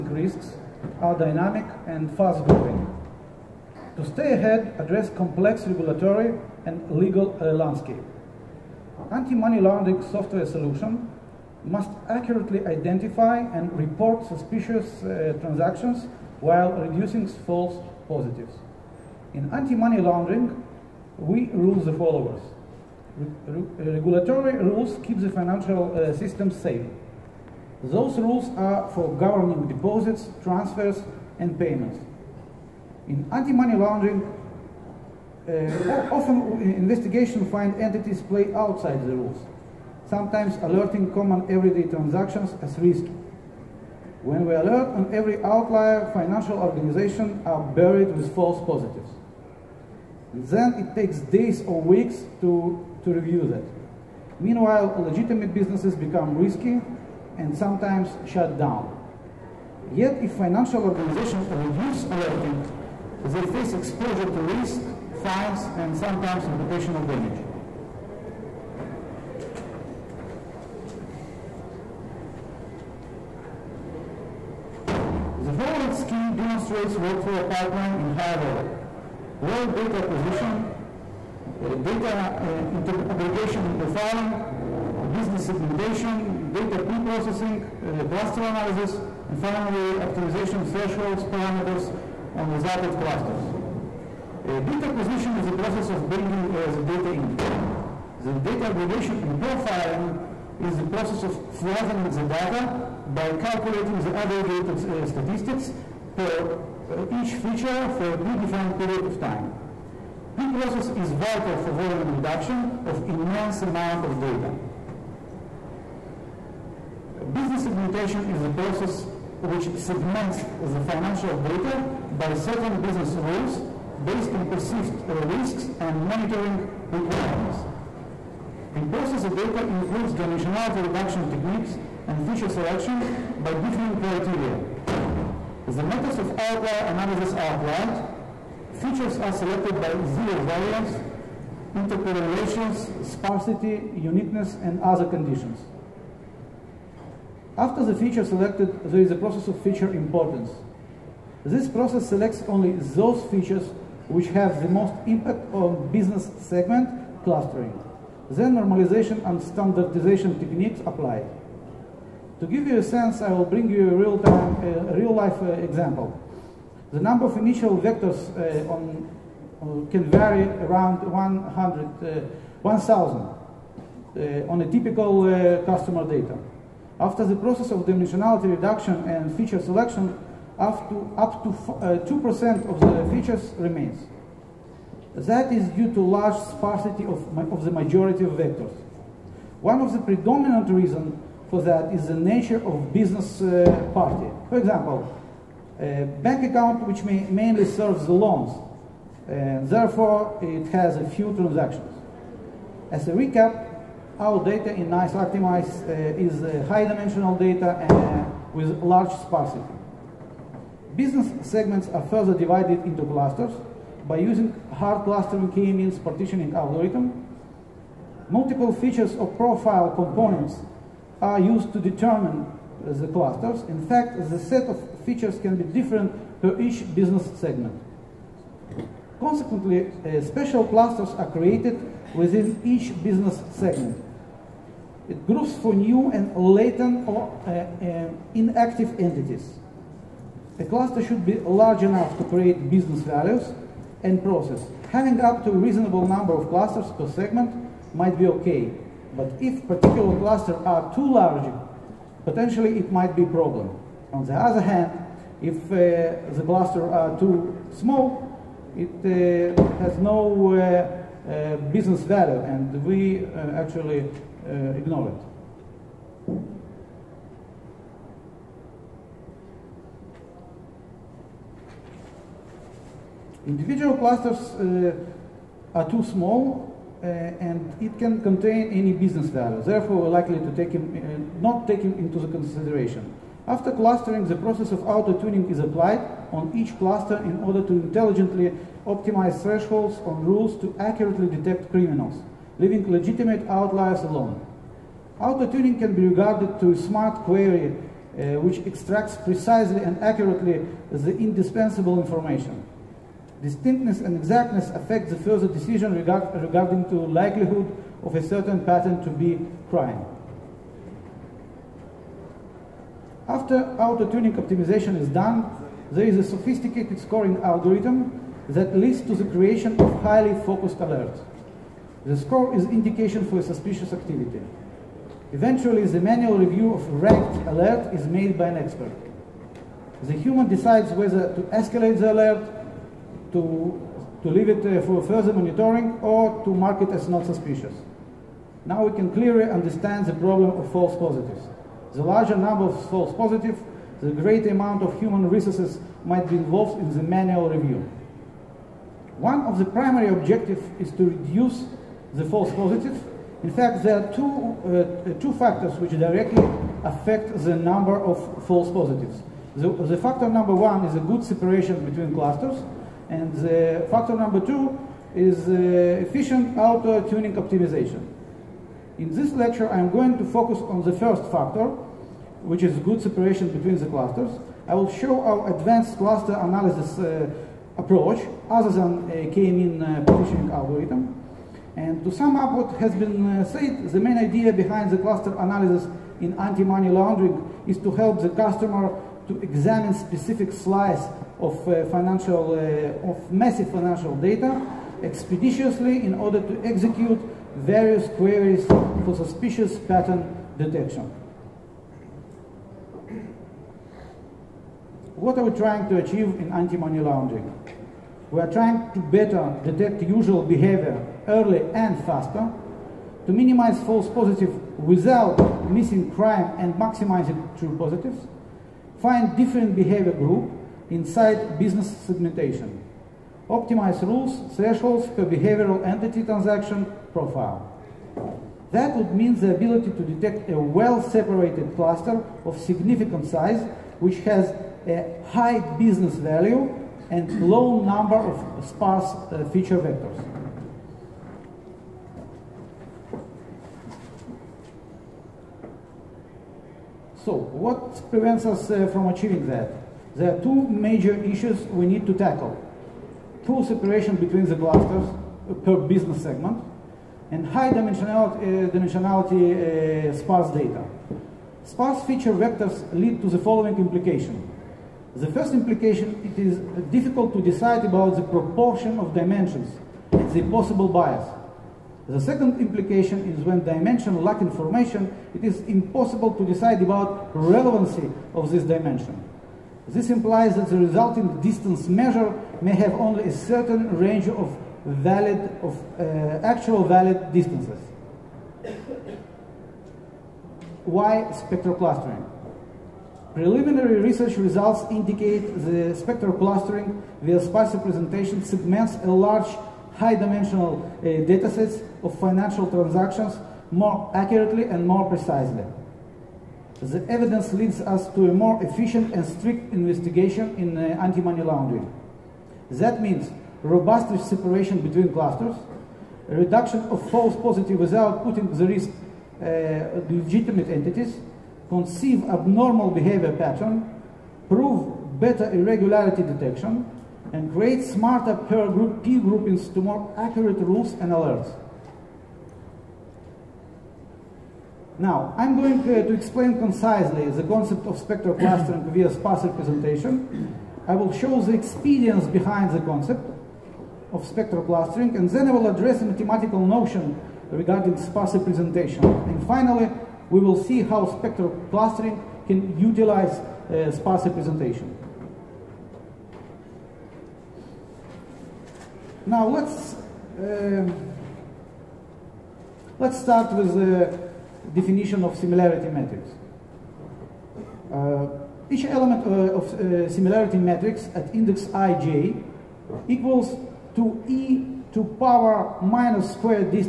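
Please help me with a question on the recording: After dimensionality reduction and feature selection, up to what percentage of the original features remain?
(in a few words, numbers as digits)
2%.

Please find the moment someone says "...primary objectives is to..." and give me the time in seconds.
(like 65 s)
349 s.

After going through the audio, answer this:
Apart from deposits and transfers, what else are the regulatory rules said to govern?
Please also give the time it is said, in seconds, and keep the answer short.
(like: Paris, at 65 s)
payments, at 31 s.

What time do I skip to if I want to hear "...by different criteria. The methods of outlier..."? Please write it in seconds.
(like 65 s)
133 s.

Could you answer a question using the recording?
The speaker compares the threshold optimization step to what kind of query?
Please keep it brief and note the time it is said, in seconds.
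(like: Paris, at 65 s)
smart query, at 296 s.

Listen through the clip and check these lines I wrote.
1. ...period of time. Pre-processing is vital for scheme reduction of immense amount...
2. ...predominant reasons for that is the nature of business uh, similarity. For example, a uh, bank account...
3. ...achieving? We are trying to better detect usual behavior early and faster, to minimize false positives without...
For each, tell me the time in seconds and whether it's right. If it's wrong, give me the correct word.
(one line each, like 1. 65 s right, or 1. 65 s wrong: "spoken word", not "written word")
1. 108 s wrong: "volume", not "scheme"
2. 189 s wrong: "party", not "similarity"
3. 406 s wrong: "laundering", not "achieving".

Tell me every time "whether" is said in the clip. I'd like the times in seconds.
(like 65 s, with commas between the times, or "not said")
330 s.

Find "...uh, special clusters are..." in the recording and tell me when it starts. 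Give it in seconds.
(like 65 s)
229 s.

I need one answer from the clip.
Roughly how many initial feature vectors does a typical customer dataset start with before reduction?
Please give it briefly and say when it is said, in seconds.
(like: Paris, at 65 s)
1,000, at 171 s.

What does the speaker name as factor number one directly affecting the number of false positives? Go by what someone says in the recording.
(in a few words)
good separation between clusters.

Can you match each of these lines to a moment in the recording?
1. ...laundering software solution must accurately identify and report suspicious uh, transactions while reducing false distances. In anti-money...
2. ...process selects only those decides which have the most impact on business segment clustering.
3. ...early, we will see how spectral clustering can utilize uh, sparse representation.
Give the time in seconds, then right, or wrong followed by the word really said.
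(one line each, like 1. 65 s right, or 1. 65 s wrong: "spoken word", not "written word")
1. 9 s wrong: "positives", not "distances"
2. 151 s wrong: "features", not "decides"
3. 549 s wrong: "finally", not "early".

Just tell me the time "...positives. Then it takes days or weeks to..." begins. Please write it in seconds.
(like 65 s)
48 s.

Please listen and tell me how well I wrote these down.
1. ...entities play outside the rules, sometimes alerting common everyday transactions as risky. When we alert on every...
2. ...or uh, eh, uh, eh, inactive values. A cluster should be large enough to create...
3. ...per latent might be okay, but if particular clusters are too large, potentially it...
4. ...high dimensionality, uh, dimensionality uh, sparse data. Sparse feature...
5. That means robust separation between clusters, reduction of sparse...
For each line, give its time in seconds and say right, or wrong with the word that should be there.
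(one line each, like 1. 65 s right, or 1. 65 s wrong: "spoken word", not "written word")
1. 37 s right
2. 237 s wrong: "entities", not "values"
3. 246 s wrong: "segment", not "latent"
4. 457 s right
5. 512 s wrong: "false", not "sparse".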